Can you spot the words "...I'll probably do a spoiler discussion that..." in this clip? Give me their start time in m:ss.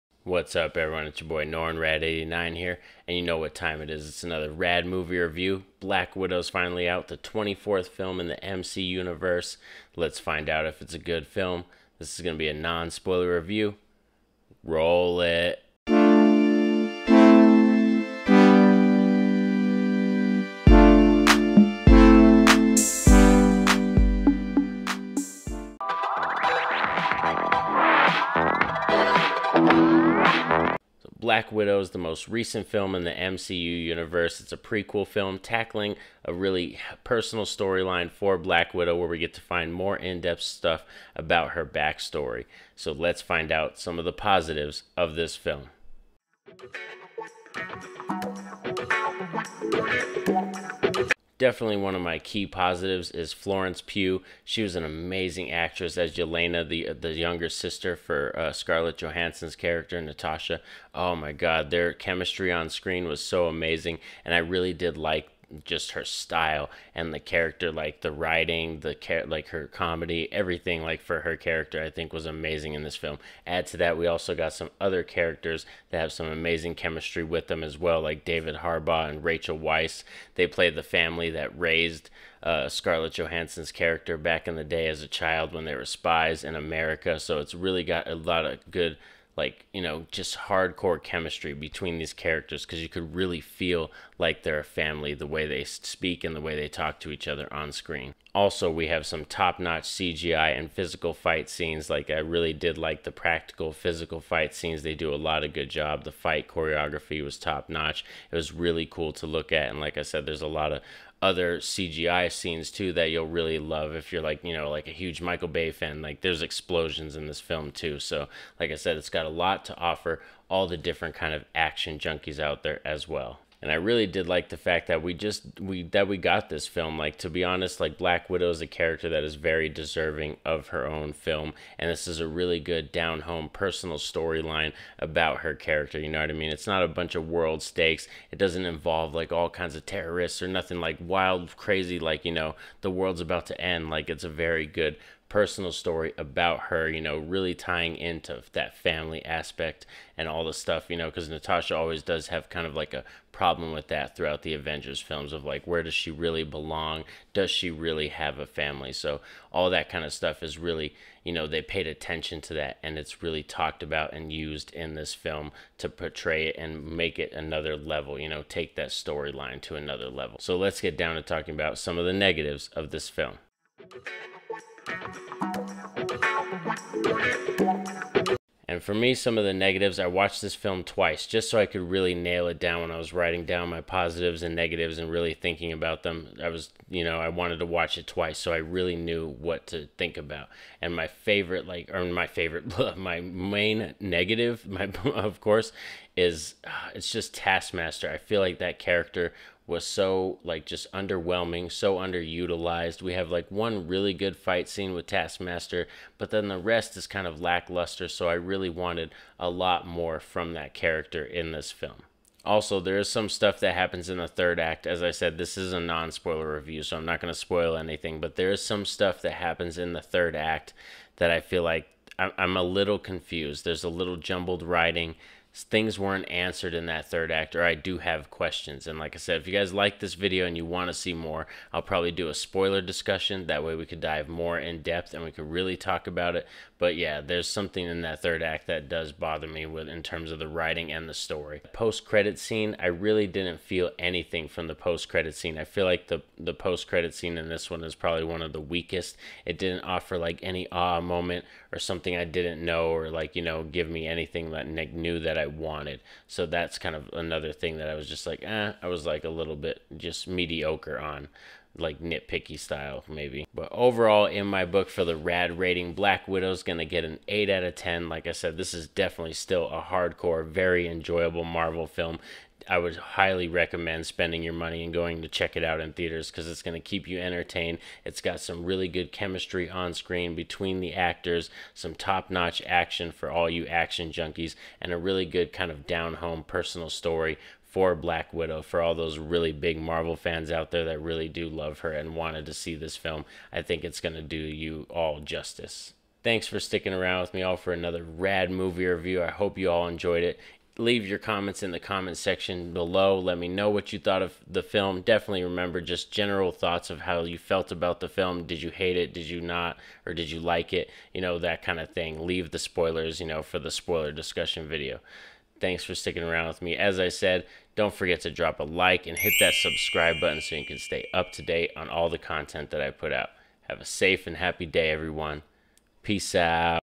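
3:51.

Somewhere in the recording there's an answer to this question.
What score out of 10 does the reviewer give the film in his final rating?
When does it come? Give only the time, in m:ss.
4:27.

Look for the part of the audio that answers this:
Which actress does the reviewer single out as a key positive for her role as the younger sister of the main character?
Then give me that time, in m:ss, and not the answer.
0:53.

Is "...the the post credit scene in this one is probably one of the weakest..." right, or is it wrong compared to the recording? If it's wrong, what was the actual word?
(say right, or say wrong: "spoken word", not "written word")
right.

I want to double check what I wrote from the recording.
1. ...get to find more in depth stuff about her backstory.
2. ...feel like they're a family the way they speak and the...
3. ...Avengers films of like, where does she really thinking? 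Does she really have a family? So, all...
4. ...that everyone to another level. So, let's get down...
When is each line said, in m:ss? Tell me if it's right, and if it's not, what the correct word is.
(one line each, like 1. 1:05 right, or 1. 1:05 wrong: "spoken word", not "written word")
1. 0:39 right
2. 1:33 right
3. 2:34 wrong: "belong", not "thinking"
4. 2:48 wrong: "storyline", not "everyone".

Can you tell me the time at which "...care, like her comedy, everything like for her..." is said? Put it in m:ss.
1:08.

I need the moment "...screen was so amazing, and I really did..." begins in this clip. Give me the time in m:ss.
1:02.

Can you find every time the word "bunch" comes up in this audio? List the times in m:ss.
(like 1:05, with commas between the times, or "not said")
2:16.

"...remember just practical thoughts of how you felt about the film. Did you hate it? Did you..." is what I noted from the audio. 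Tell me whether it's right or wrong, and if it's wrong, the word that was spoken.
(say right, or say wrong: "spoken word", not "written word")
wrong: "general", not "practical".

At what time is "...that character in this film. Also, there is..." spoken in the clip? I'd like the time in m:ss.
3:30.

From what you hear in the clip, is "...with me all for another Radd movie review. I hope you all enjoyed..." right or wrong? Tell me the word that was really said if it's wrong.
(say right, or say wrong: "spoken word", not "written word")
right.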